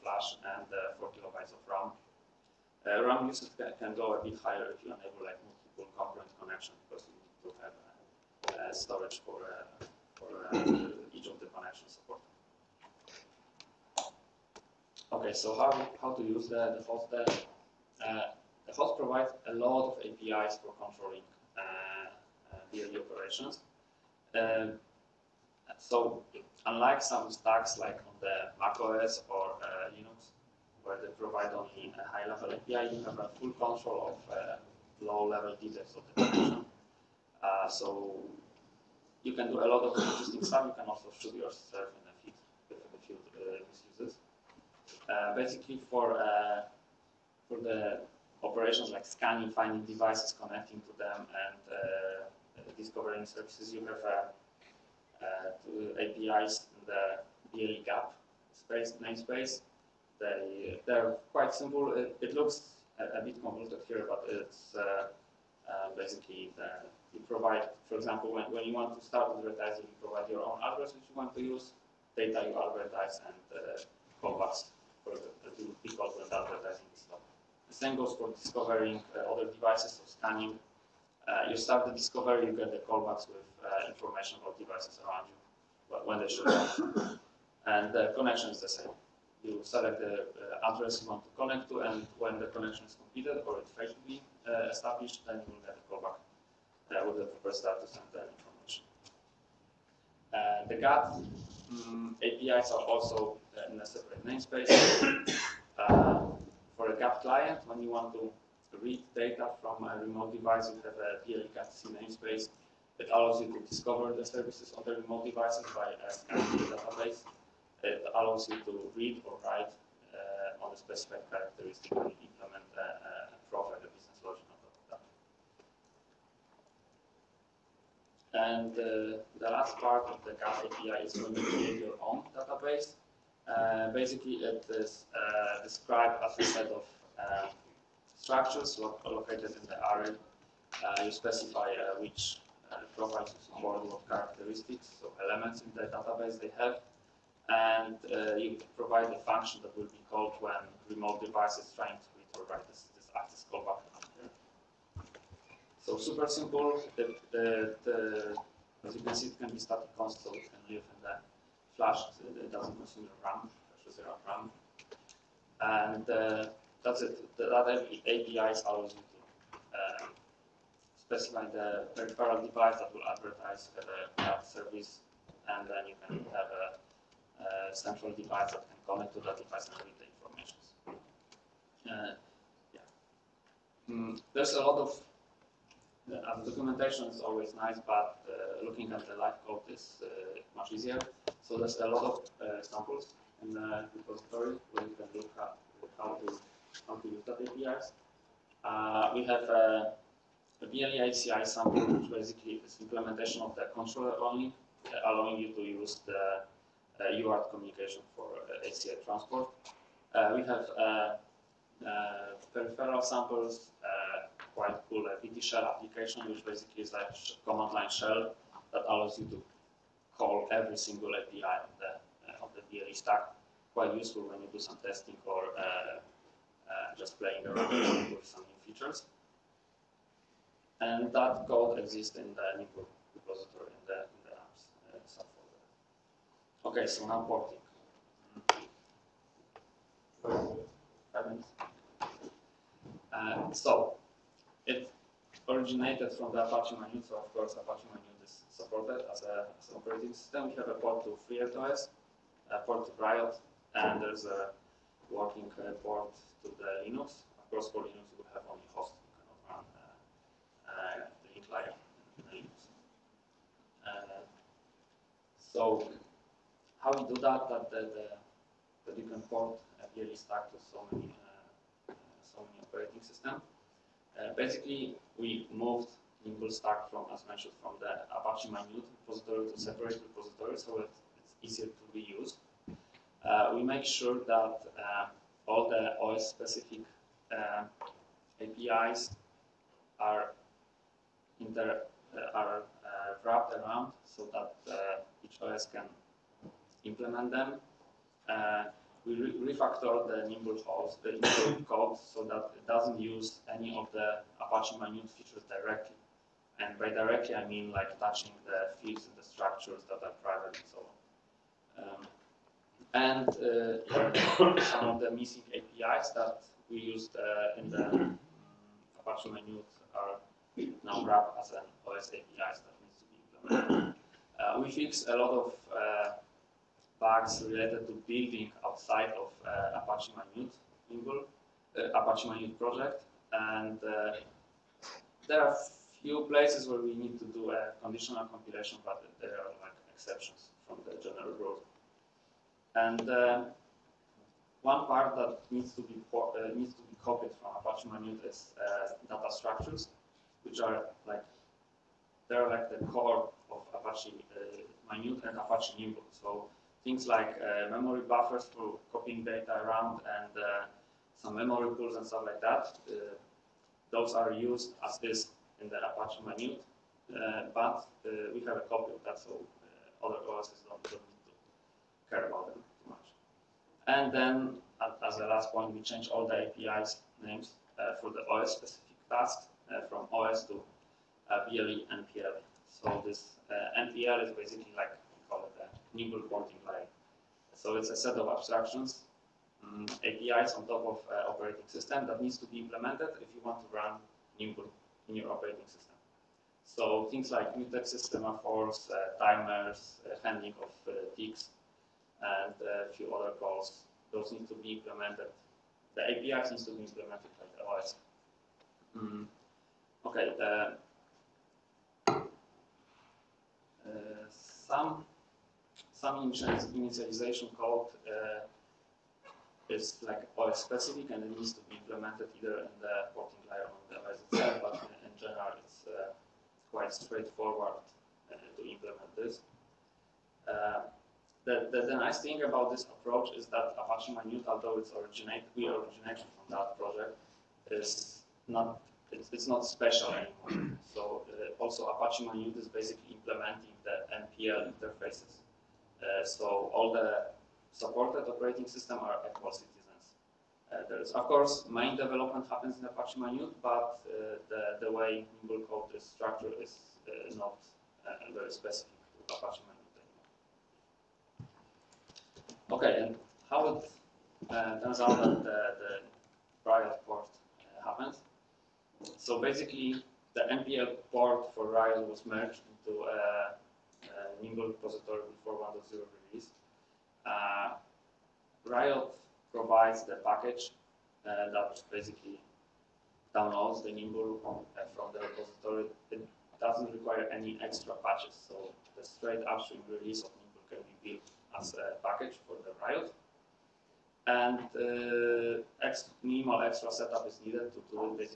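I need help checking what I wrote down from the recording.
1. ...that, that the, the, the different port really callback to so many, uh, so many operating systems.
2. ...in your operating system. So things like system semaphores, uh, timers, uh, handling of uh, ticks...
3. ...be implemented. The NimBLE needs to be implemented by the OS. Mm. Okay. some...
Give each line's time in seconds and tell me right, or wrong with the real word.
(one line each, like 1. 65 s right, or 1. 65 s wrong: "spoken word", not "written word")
1. 267 s wrong: "stuck", not "callback"
2. 395 s right
3. 404 s wrong: "APIs", not "NimBLE".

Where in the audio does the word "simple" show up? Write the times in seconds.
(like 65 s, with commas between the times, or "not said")
61 s, 156 s.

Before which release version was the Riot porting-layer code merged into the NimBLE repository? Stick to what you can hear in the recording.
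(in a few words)
1.0.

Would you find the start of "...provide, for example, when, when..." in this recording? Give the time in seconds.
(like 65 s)
67 s.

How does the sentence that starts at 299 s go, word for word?
we re refactor the NimBLE host, the NimBLE code, so that it doesn't use any of the Apache Mynewt features directly.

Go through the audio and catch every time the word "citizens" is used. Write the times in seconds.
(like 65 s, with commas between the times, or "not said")
449 s.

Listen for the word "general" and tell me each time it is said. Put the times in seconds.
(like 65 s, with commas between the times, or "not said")
341 s.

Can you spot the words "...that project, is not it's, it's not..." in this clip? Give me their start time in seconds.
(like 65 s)
436 s.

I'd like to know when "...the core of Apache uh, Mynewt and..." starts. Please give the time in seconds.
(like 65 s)
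352 s.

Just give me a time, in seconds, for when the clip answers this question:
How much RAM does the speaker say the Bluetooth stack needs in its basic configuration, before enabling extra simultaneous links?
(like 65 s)
0 s.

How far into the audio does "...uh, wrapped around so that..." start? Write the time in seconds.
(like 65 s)
292 s.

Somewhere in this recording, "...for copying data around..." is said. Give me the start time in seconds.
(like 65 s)
358 s.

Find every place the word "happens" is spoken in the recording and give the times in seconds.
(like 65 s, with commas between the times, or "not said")
452 s, 467 s.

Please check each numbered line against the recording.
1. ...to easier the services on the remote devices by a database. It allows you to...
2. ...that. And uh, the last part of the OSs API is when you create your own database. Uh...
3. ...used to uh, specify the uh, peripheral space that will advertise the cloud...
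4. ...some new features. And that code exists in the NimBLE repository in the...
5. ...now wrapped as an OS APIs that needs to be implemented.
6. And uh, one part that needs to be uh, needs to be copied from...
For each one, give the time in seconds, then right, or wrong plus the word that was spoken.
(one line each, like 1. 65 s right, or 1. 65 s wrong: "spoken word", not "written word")
1. 113 s wrong: "discover", not "easier"
2. 128 s wrong: "GAP", not "OSs"
3. 168 s wrong: "device", not "space"
4. 228 s right
5. 320 s right
6. 342 s right.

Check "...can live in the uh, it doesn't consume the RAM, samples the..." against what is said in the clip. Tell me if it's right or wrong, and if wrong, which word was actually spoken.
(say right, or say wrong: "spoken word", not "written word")
wrong: "flashes", not "samples".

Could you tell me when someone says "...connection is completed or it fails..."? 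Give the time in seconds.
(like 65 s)
92 s.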